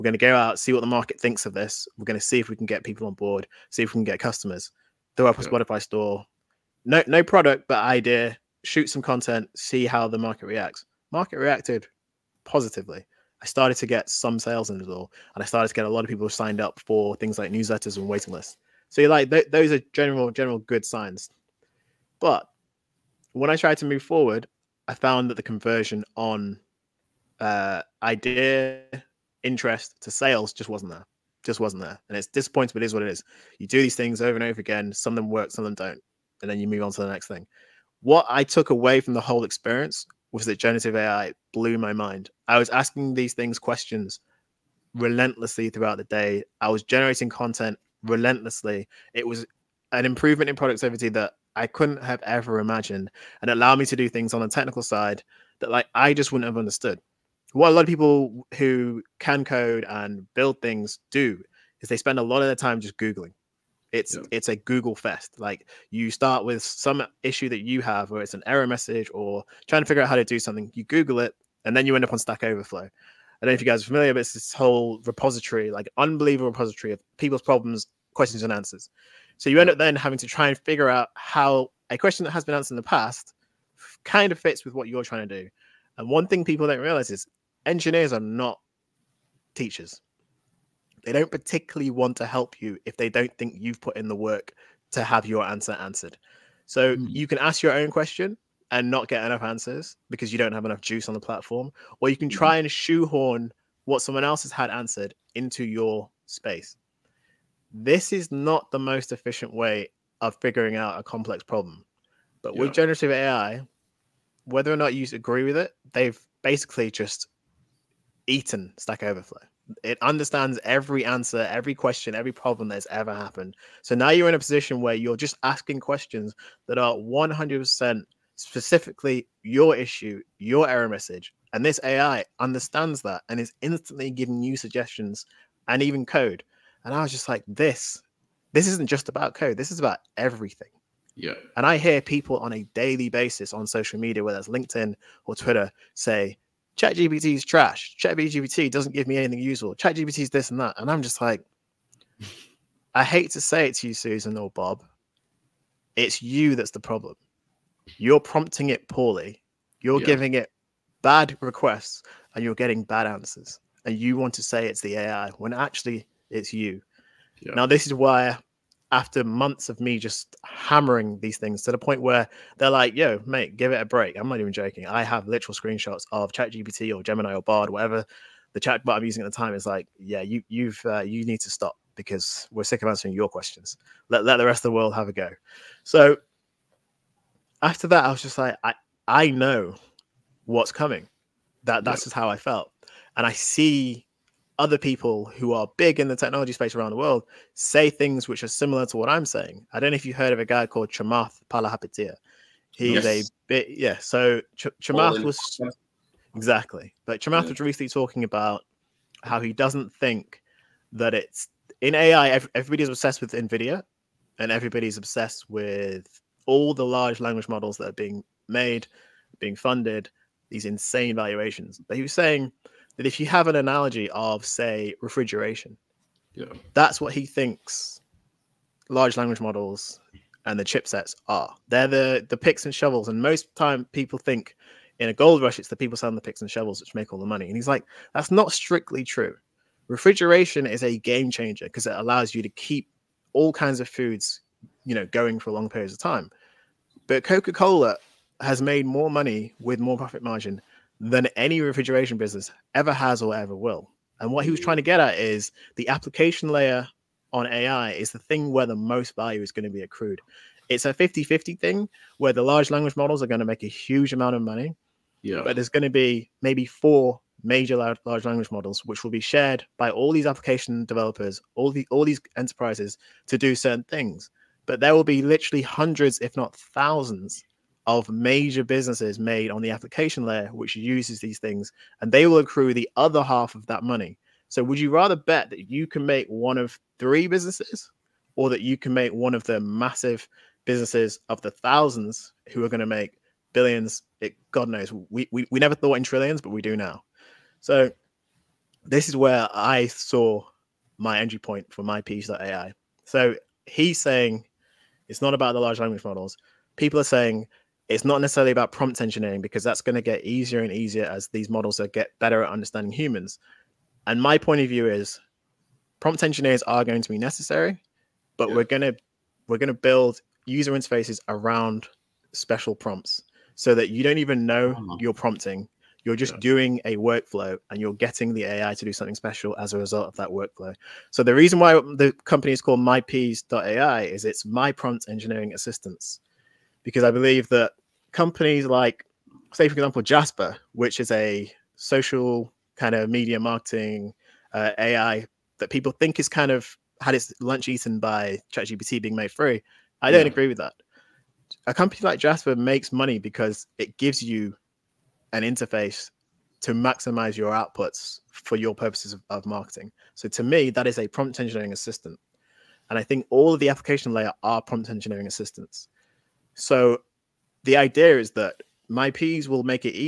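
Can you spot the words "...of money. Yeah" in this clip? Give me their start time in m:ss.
4:24.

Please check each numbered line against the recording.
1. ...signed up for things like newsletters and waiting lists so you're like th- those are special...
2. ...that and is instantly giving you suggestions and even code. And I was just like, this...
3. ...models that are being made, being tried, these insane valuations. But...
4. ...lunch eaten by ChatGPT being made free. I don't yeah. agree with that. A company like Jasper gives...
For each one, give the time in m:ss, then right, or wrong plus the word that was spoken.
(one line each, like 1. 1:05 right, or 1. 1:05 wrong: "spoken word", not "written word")
1. 0:16 wrong: "general", not "special"
2. 2:13 right
3. 3:37 wrong: "funded", not "tried"
4. 5:47 wrong: "makes", not "gives".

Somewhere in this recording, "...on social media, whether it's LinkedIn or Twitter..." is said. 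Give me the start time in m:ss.
2:23.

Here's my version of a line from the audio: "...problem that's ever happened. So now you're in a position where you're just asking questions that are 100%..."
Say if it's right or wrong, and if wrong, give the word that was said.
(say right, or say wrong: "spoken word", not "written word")
right.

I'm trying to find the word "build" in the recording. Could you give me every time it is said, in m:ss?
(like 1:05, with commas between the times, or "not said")
1:00, 5:19.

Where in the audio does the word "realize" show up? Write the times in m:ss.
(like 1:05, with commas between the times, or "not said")
1:26.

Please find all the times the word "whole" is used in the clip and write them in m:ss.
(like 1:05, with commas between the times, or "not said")
0:39, 1:14.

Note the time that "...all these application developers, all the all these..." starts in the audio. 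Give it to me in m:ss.
4:29.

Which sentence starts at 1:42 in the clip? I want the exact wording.
try and shoehorn what someone else has had answered into your space.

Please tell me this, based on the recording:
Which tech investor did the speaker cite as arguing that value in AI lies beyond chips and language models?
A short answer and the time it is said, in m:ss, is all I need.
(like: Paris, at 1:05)
Chamath Palihapitiya, at 3:20.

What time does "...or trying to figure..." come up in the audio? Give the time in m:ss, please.
1:09.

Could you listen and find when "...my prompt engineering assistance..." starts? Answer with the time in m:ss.
5:34.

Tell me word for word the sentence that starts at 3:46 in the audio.
that's what he thinks large language models and the chipsets are.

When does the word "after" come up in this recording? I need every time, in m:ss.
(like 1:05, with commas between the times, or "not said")
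2:48, 3:07.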